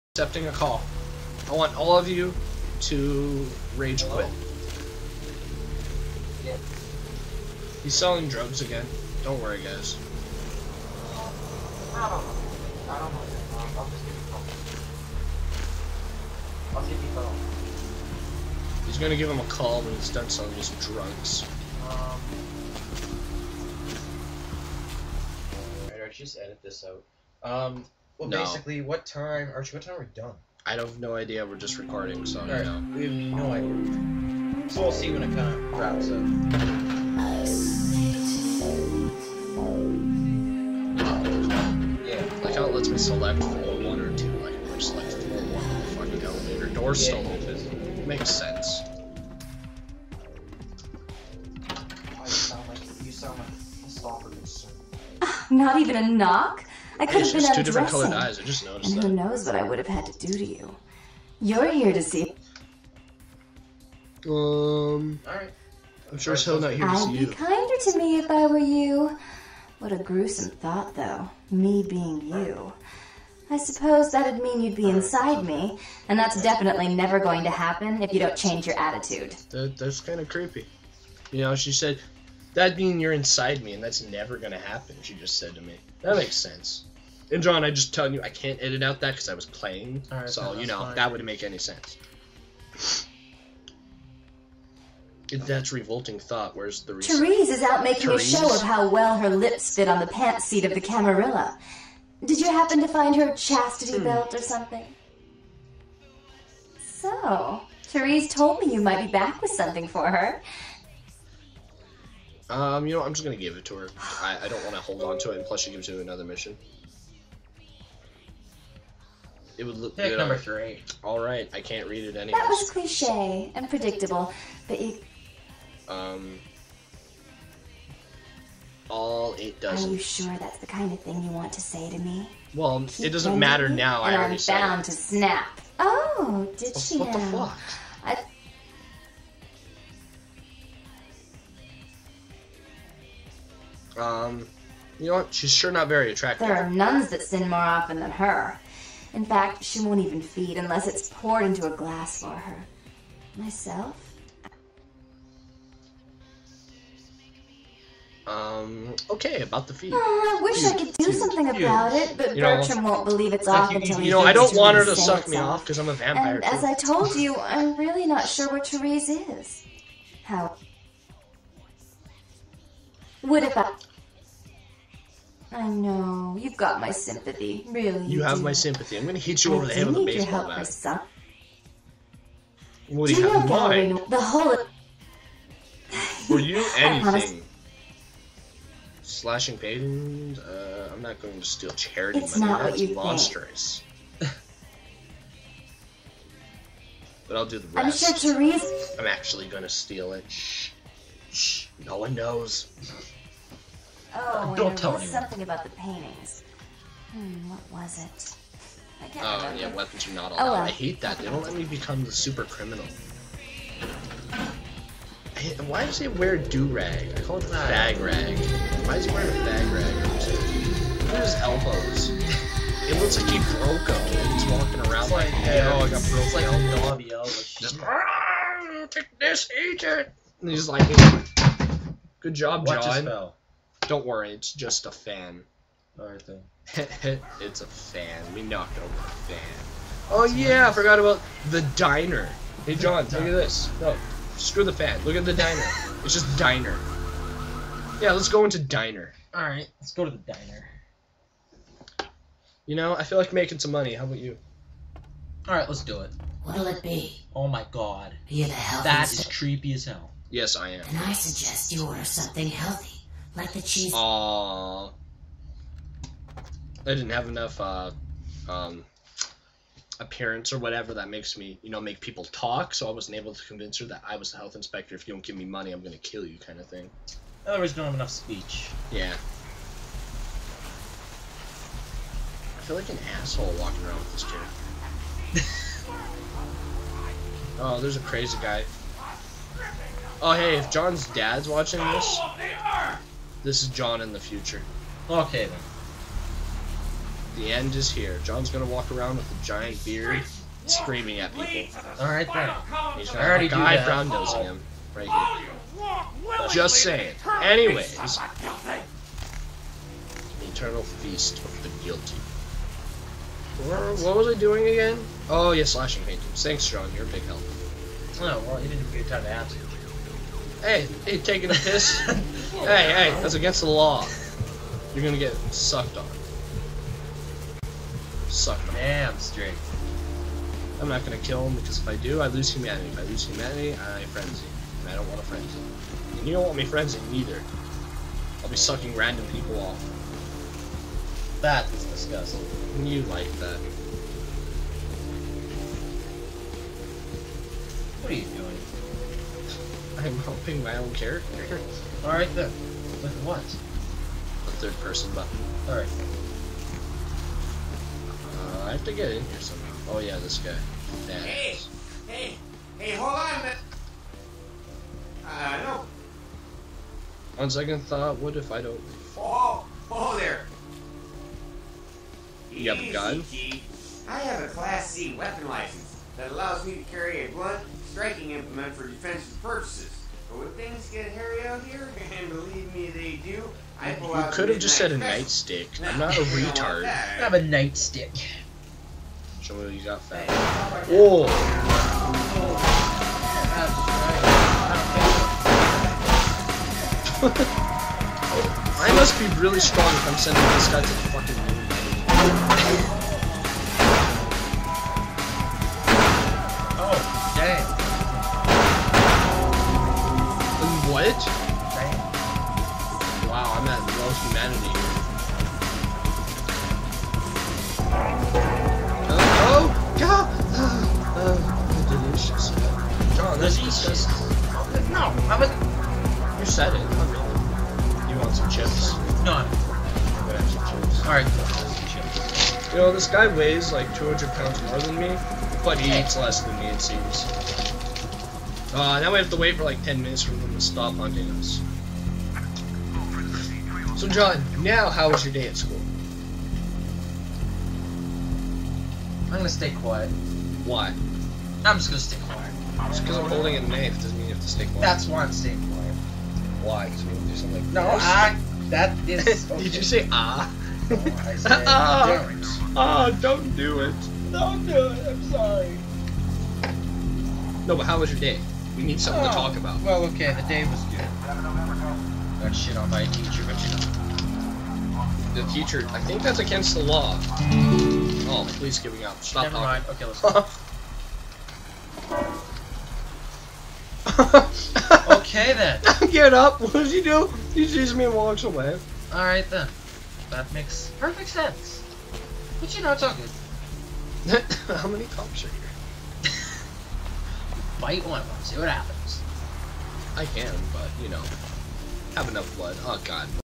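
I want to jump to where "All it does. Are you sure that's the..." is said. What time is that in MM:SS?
02:08.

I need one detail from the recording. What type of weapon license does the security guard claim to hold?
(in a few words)
Class C.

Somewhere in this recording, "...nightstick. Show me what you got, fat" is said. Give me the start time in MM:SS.
06:27.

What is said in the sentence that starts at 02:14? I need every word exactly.
I already I'm bound to snap.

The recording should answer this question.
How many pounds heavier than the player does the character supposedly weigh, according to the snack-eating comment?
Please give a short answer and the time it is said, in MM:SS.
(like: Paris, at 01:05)
200, at 07:13.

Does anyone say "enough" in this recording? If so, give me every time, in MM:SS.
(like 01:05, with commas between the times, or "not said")
04:27, 04:37, 08:22.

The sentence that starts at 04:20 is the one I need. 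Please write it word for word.
Then I suggest you order something healthy like the cheese.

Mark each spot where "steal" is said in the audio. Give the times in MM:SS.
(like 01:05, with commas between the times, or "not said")
03:11, 03:19.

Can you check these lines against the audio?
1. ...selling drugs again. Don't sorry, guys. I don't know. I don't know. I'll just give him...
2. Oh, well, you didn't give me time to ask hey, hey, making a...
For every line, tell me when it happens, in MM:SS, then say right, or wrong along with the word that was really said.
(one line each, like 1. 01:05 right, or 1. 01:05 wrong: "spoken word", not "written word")
1. 00:07 wrong: "worry", not "sorry"
2. 05:18 wrong: "taking", not "making".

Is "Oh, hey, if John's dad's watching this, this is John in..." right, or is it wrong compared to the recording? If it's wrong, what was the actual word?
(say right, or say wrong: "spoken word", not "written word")
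right.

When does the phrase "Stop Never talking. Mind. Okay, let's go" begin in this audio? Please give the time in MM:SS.
07:59.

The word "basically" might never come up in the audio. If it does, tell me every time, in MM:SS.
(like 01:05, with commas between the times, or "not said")
00:28.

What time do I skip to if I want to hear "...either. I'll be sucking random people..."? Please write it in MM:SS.
05:37.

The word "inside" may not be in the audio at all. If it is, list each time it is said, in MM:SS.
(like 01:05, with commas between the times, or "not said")
01:14, 01:23.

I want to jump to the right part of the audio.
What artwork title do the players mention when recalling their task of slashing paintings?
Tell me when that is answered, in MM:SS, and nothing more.
05:10.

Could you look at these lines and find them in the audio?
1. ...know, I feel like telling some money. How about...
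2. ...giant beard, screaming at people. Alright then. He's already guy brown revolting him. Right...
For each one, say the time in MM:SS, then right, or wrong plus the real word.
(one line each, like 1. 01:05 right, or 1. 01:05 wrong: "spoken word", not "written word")
1. 04:12 wrong: "making", not "telling"
2. 04:59 wrong: "nosing", not "revolting".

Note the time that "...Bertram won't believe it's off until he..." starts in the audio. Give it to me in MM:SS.
02:42.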